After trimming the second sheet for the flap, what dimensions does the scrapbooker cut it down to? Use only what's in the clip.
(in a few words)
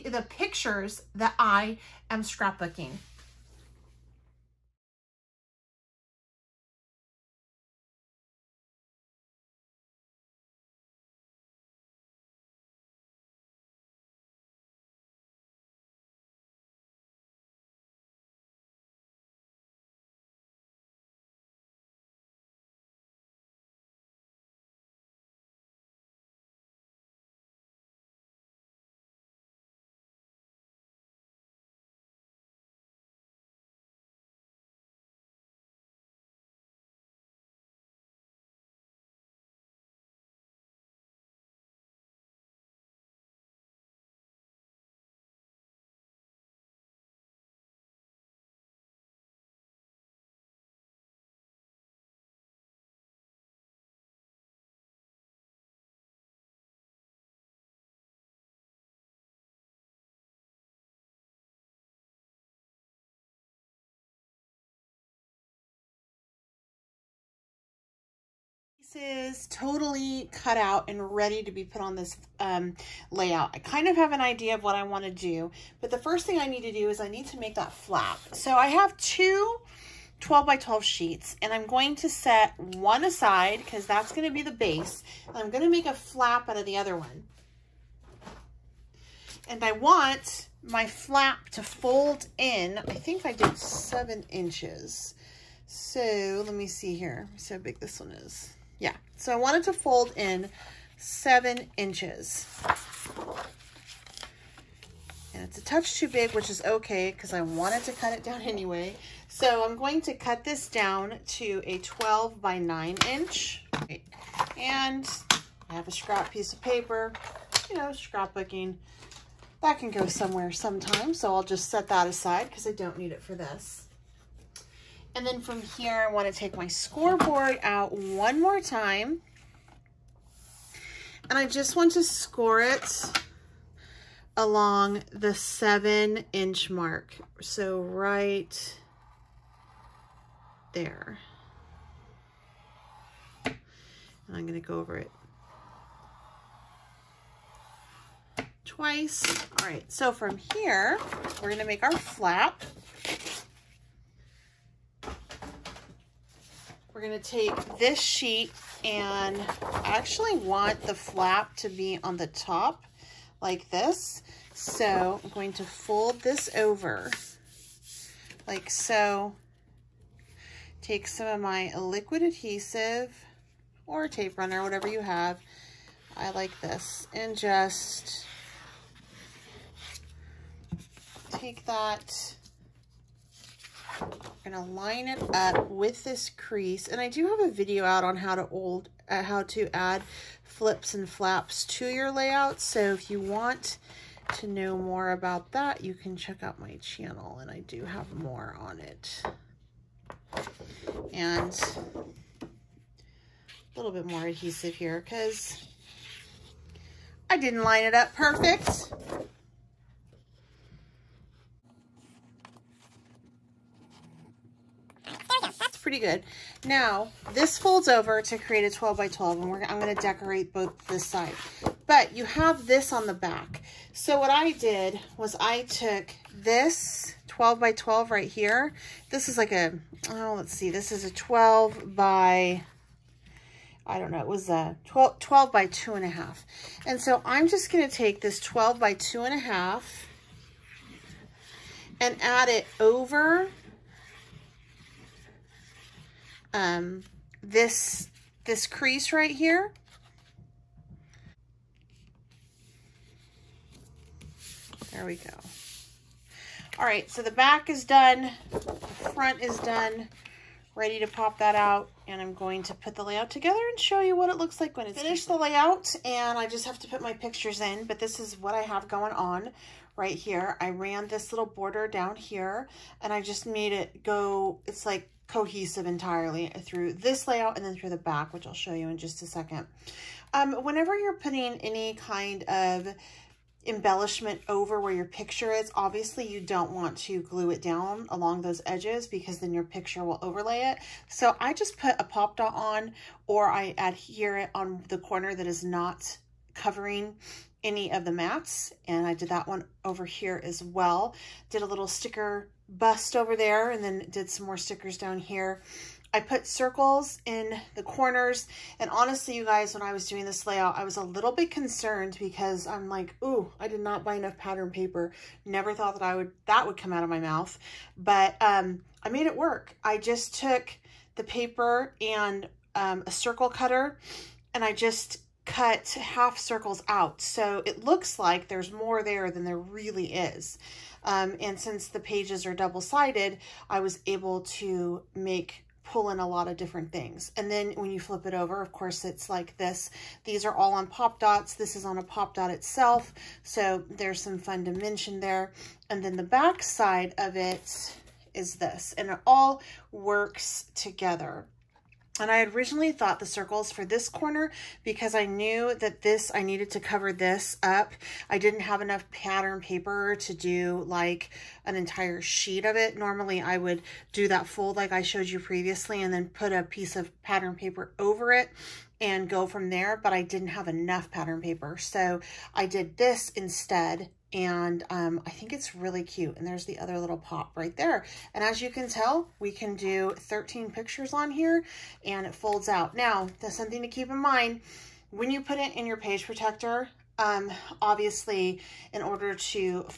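12 by 9 inch.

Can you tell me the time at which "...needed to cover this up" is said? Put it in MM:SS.
05:56.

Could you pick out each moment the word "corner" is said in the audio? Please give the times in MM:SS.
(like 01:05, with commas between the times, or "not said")
04:54, 05:07, 05:54.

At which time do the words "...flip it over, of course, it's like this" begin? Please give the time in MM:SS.
05:37.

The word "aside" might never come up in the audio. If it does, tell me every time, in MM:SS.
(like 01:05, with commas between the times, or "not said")
01:23, 02:02.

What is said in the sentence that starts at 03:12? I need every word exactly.
So if you want to know more about that, you can check out my channel and I do have more on it.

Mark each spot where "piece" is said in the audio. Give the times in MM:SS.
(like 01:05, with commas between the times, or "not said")
01:56, 06:06.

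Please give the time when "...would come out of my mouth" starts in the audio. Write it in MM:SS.
05:16.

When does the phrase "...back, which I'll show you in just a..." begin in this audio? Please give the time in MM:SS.
04:37.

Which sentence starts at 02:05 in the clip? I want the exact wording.
And then from here, I want to take my scoreboard out one more time.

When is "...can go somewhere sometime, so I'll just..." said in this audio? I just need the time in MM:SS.
01:59.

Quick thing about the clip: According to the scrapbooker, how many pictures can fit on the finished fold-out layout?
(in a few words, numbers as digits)
13.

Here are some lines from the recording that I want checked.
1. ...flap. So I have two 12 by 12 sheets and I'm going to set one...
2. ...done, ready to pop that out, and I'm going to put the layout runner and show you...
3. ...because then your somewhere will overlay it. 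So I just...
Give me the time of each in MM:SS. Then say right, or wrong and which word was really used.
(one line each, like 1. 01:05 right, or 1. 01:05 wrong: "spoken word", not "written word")
1. 01:17 right
2. 04:19 wrong: "together", not "runner"
3. 04:49 wrong: "picture", not "somewhere".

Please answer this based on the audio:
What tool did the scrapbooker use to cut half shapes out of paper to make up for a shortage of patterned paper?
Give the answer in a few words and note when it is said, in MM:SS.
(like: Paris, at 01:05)
circle cutter, at 05:23.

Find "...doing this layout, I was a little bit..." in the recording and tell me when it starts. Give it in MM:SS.
05:10.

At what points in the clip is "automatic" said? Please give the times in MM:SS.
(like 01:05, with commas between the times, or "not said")
not said.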